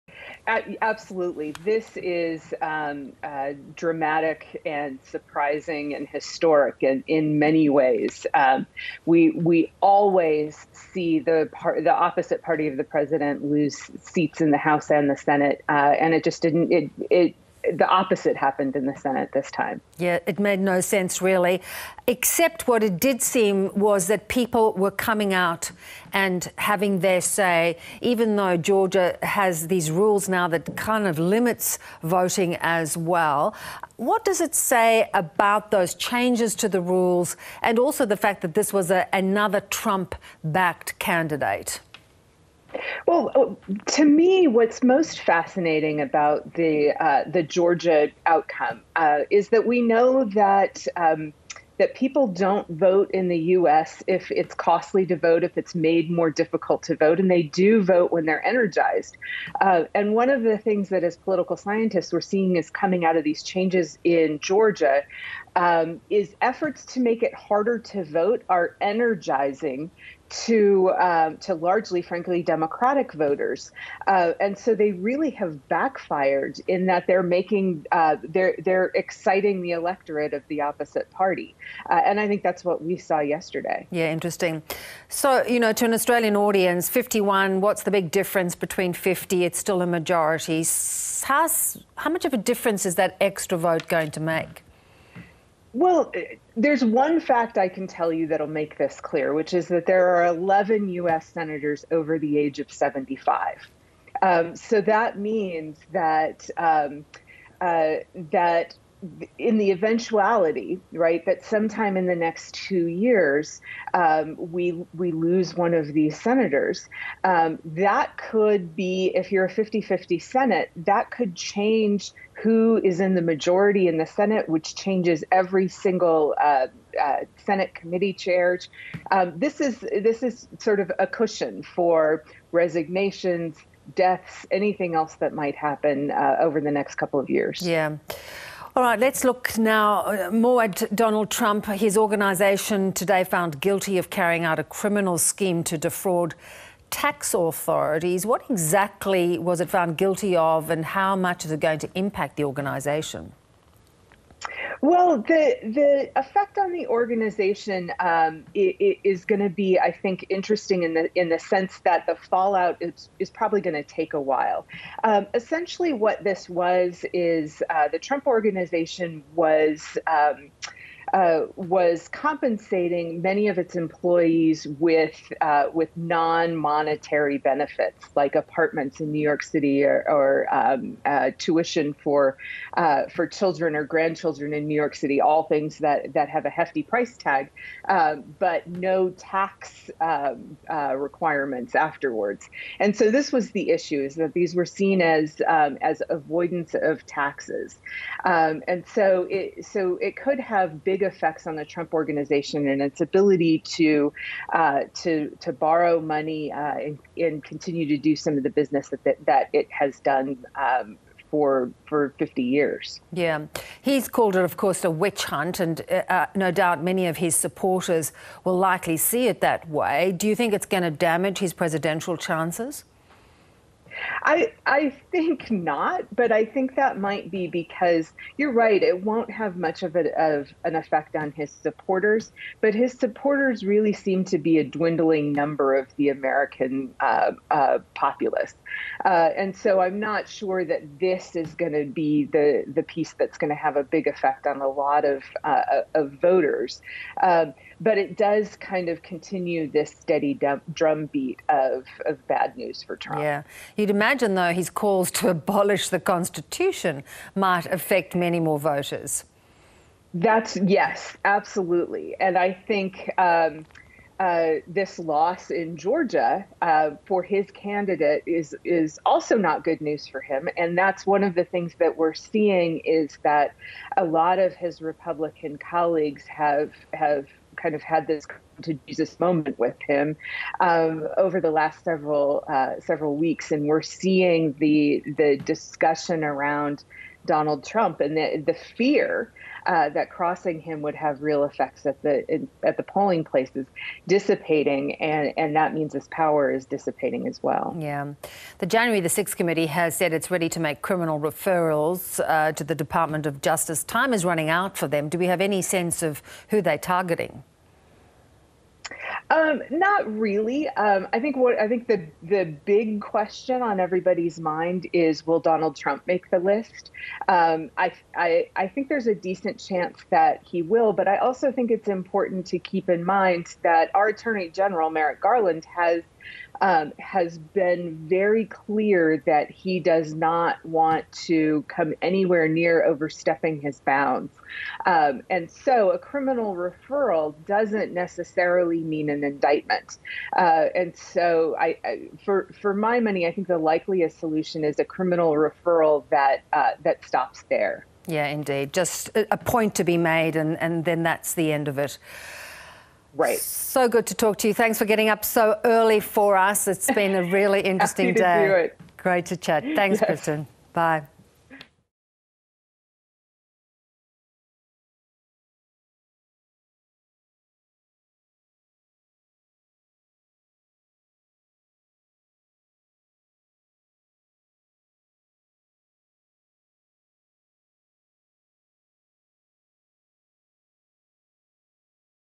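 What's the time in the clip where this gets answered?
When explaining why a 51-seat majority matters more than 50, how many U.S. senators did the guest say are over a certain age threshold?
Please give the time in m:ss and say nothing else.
1:40.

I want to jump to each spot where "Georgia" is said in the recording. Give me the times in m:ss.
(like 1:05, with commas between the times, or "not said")
0:28, 0:47, 1:04, 4:25.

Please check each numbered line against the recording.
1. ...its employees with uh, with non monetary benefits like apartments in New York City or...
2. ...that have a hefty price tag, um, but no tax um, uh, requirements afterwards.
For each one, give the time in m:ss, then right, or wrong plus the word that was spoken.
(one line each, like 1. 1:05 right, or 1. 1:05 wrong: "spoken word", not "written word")
1. 2:53 right
2. 3:06 right.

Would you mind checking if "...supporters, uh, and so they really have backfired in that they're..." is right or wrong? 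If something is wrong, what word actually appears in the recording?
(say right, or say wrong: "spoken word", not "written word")
wrong: "voters", not "supporters".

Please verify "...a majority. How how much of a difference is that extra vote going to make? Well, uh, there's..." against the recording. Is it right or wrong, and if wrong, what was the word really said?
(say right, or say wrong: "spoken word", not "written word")
right.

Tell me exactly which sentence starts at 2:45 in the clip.
Um, essentially, what this was is uh, the Trump organization was.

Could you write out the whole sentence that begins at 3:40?
Do you think it's going to damage his presidential chances?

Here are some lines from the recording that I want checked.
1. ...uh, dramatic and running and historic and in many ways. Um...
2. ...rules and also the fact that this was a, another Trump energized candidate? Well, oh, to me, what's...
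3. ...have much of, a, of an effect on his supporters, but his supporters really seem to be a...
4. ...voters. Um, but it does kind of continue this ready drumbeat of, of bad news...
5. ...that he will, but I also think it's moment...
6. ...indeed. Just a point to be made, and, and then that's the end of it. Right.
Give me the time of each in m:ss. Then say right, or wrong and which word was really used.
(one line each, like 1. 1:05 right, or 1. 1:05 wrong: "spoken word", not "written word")
1. 0:03 wrong: "surprising", not "running"
2. 0:36 wrong: "backed", not "energized"
3. 3:49 right
4. 4:06 wrong: "steady", not "ready"
5. 5:20 wrong: "important", not "moment"
6. 5:48 right.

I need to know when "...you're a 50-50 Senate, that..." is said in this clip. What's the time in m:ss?
1:59.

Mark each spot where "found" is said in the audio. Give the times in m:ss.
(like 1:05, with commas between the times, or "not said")
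2:23, 2:29.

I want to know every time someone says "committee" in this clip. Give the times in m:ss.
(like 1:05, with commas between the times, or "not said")
2:07, 4:59.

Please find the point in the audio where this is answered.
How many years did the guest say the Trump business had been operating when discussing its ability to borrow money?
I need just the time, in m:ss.
3:32.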